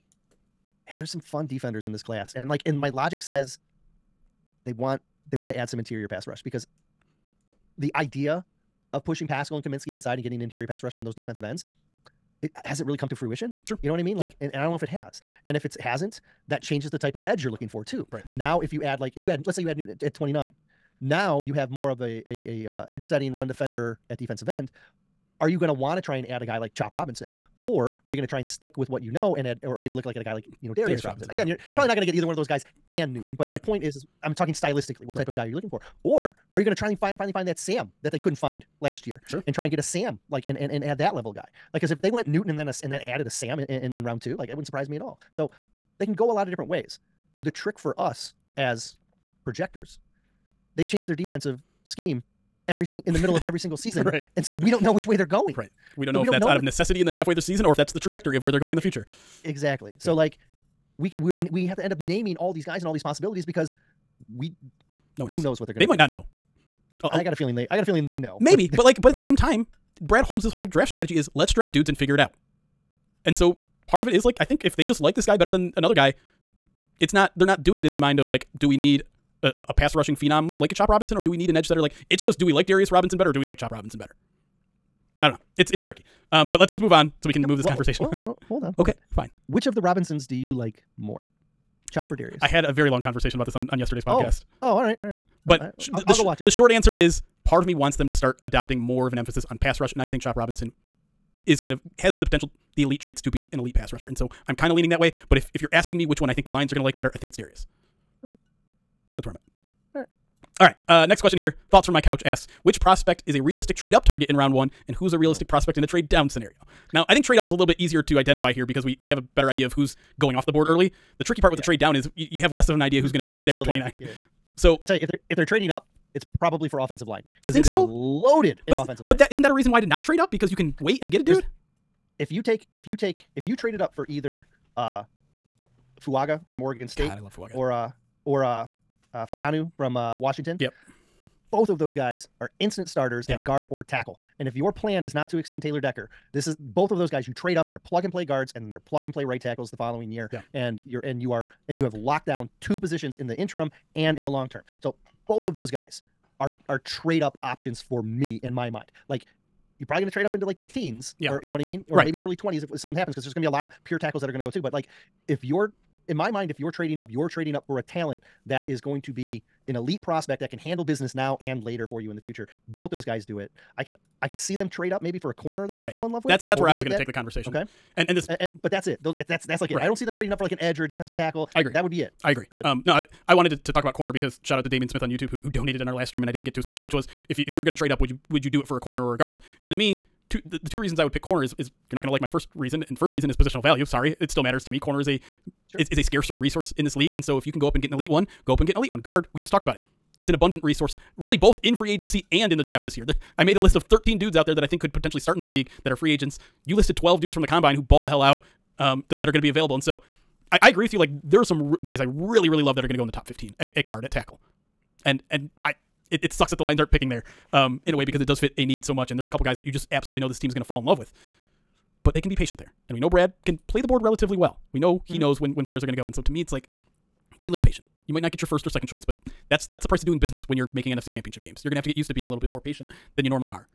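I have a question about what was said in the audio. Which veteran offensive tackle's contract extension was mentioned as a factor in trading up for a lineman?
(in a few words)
Taylor Decker.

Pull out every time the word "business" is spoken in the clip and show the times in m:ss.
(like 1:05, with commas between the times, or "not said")
2:50, 3:50.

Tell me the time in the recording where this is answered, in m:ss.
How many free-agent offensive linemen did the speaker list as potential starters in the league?
3:23.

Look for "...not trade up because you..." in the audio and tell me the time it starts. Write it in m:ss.
2:09.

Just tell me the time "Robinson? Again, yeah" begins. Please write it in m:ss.
0:31.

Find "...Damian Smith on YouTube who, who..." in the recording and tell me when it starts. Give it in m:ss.
3:04.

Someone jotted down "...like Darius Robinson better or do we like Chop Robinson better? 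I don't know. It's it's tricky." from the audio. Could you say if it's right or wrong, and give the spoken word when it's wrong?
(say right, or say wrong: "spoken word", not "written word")
right.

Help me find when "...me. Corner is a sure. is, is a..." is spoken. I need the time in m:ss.
3:14.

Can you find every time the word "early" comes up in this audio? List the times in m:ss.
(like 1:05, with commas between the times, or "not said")
2:00, 2:42.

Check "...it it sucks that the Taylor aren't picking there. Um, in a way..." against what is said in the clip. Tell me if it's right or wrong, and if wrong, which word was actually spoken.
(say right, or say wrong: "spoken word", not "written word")
wrong: "Lions", not "Taylor".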